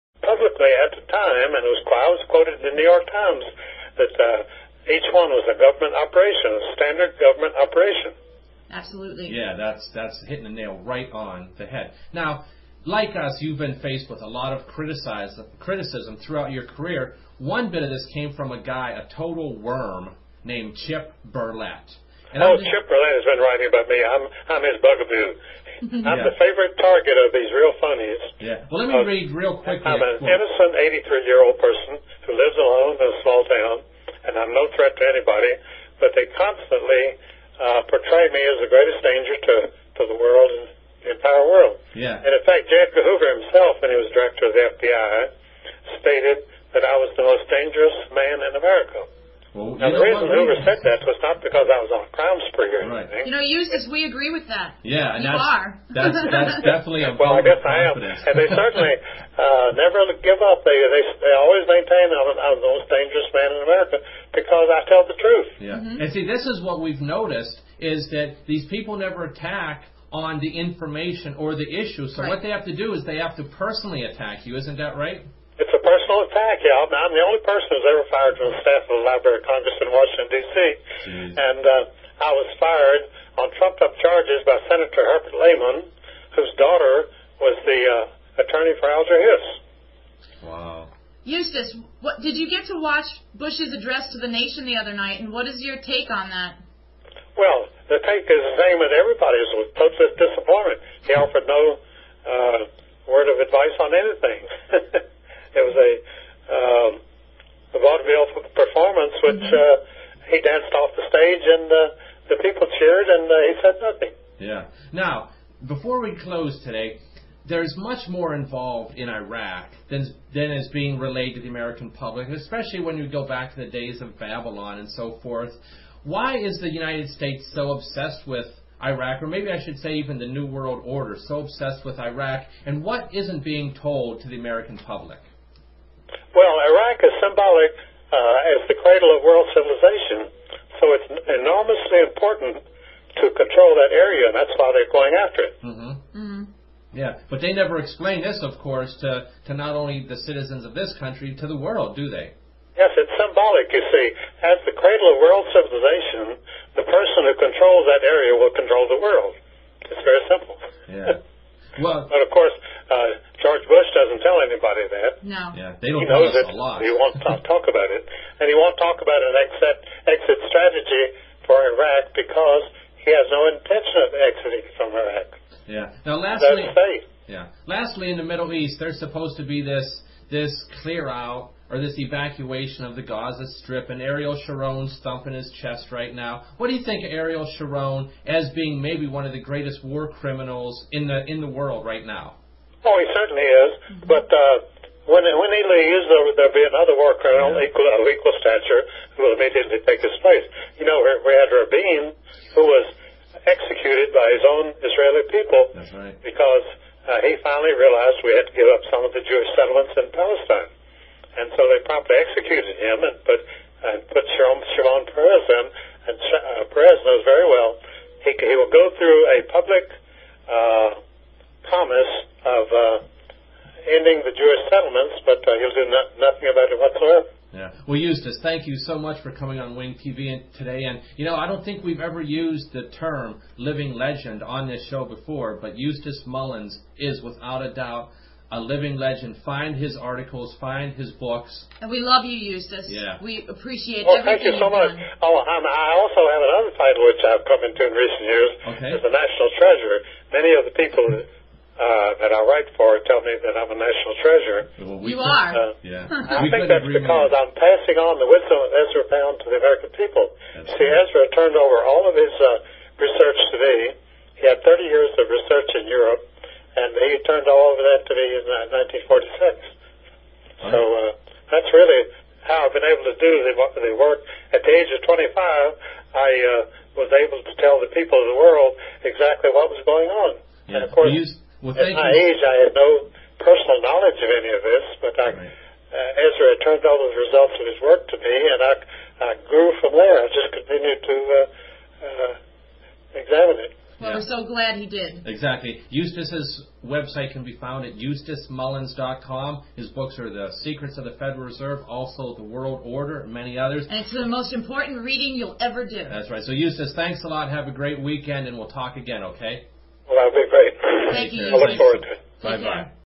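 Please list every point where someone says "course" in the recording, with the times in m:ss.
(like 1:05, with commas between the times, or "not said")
2:28, 2:42, 4:40.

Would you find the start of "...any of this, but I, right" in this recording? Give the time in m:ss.
4:44.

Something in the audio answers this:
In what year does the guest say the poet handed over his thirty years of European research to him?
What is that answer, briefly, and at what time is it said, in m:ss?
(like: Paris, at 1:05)
1946, at 4:29.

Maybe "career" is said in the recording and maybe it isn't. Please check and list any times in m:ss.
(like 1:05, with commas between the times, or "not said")
0:16.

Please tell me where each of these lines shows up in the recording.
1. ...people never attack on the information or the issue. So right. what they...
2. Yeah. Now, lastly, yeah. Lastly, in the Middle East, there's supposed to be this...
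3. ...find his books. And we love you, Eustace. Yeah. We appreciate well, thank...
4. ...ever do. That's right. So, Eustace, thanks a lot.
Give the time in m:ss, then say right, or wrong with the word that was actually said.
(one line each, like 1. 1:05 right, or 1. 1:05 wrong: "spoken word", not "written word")
1. 1:08 right
2. 2:55 right
3. 4:00 right
4. 5:05 right.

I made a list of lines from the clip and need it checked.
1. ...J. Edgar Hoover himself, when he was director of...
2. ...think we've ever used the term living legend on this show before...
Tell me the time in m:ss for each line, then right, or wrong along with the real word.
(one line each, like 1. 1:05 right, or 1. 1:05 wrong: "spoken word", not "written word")
1. 0:42 right
2. 3:51 right.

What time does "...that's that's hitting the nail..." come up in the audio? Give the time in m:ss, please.
0:09.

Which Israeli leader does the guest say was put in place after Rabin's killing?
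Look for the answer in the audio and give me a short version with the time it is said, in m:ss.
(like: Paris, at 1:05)
Shimon Peres, at 3:34.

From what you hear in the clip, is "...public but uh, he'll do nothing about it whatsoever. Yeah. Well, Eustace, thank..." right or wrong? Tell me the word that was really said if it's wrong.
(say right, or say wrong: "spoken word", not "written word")
right.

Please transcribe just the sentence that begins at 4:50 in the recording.
I just continued to uh, uh, examine it.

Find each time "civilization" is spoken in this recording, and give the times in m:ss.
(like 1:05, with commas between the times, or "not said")
2:19, 2:35.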